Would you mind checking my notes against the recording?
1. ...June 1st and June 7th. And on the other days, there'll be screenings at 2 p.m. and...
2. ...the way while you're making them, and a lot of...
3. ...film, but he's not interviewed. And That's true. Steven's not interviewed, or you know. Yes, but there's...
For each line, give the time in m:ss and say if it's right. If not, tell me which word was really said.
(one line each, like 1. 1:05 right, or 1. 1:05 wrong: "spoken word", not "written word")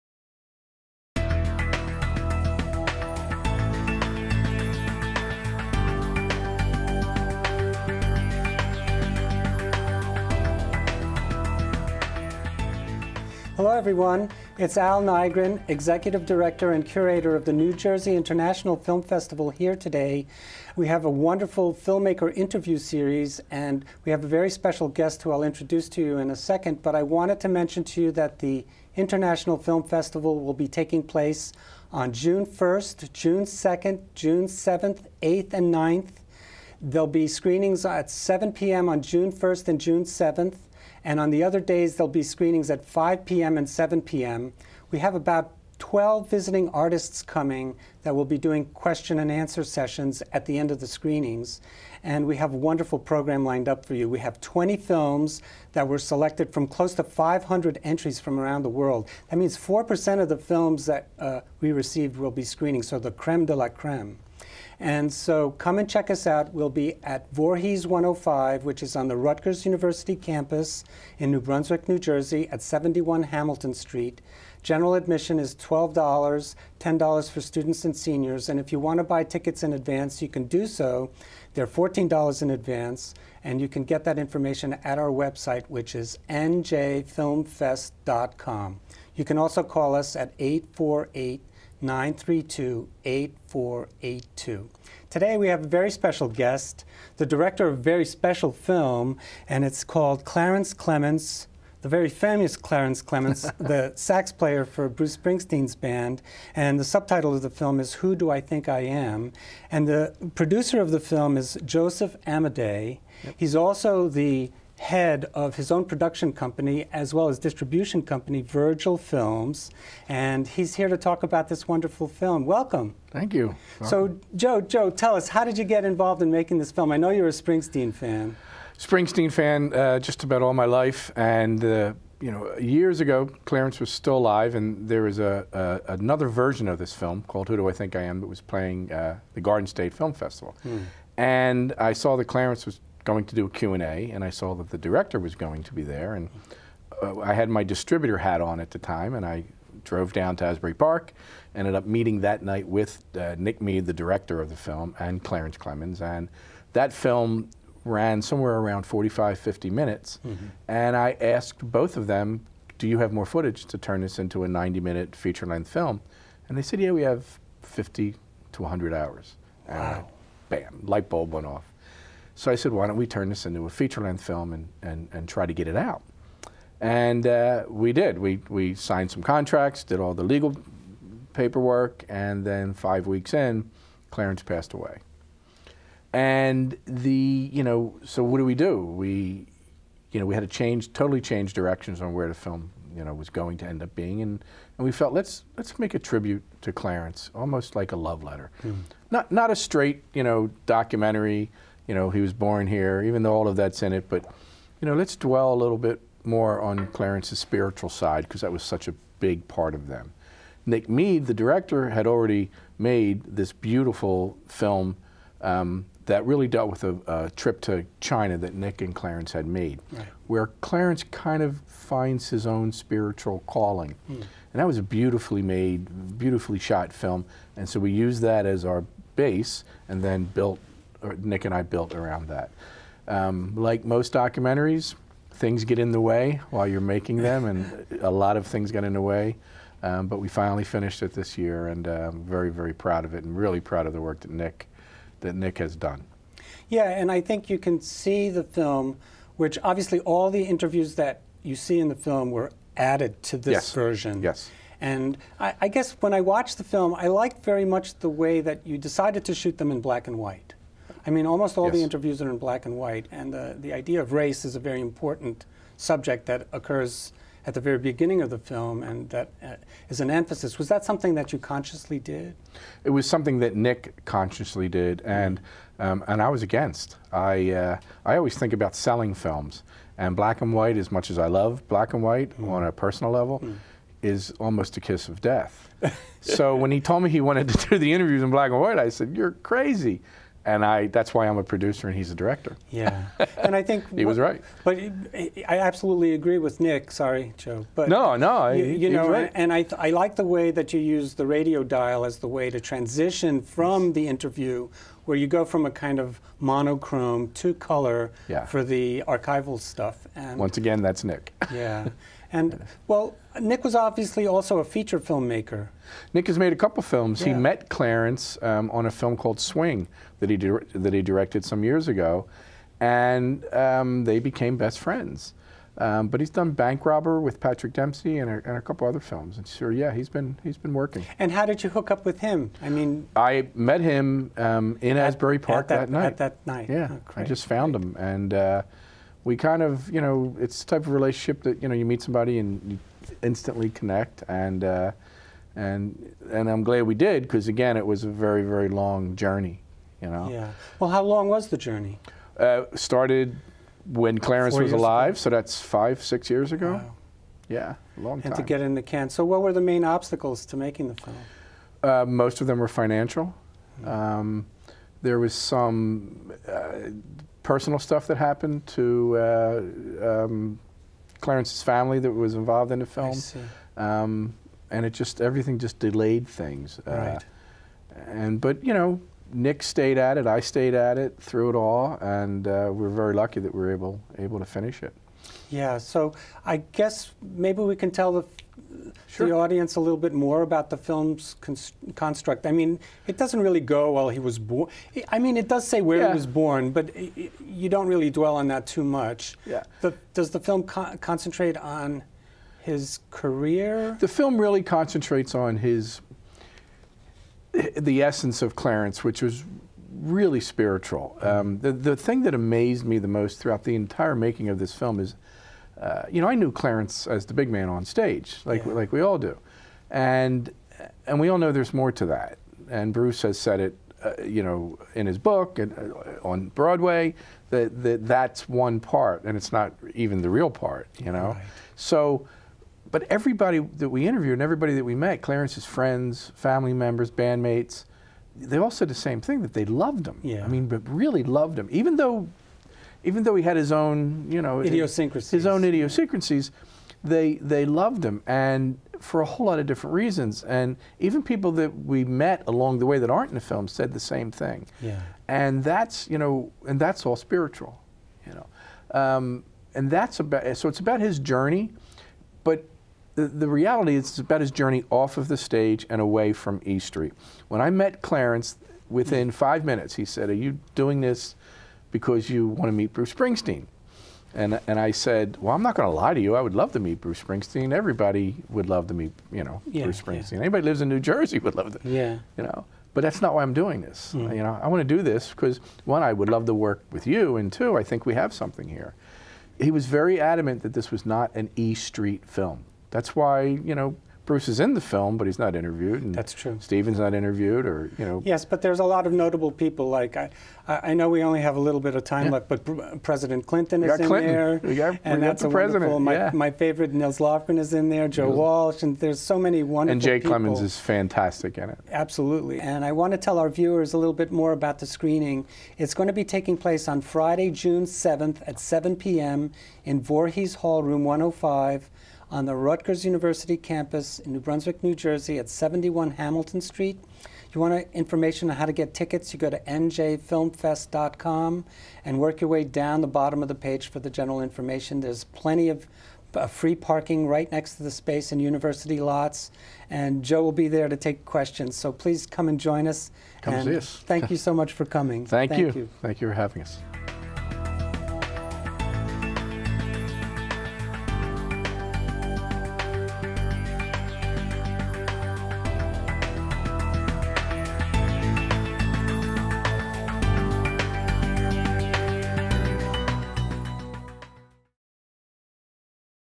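1. 0:39 wrong: "5", not "2"
2. 3:55 right
3. 8:14 right.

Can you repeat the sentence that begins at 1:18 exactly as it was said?
And if you want to buy tickets in advance, you can do so.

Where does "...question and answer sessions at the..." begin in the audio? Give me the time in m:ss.
0:48.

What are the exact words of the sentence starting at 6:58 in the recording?
like we all do, and and we all know there's more to that.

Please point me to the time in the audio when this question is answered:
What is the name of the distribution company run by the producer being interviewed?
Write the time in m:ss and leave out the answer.
1:58.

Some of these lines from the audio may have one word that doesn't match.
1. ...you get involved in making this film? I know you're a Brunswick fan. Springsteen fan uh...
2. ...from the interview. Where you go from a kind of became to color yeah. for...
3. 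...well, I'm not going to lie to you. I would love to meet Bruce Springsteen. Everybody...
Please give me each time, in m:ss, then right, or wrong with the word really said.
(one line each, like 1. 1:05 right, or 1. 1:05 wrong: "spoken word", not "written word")
1. 2:05 wrong: "Springsteen", not "Brunswick"
2. 5:03 wrong: "monochrome", not "became"
3. 7:55 right.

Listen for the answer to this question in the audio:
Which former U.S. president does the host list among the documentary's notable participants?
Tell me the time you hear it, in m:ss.
8:23.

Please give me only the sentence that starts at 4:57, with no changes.
But no, no, you, you know, right.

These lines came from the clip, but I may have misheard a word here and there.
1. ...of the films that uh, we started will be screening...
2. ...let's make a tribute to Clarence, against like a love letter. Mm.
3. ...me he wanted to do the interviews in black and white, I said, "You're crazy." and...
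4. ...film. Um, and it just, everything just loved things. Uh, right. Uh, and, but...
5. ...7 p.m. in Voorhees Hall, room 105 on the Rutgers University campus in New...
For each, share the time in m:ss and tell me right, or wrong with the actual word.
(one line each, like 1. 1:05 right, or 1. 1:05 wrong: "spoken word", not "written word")
1. 1:00 wrong: "received", not "started"
2. 3:15 wrong: "almost", not "against"
3. 4:47 right
4. 6:12 wrong: "delayed", not "loved"
5. 8:38 right.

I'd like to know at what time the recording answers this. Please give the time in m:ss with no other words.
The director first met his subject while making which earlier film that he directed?
5:19.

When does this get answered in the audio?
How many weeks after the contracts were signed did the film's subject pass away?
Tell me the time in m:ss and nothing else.
3:02.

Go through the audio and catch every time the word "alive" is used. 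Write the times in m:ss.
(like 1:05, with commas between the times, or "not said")
2:14, 5:54.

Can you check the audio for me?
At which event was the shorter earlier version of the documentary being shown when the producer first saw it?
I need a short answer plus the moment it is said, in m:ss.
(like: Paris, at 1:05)
Garden State Film Festival, at 2:19.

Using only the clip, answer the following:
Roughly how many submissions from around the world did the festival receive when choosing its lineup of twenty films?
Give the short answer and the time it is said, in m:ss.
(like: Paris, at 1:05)
500, at 0:57.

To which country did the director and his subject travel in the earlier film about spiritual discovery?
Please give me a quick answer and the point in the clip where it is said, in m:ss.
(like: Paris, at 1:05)
China, at 3:37.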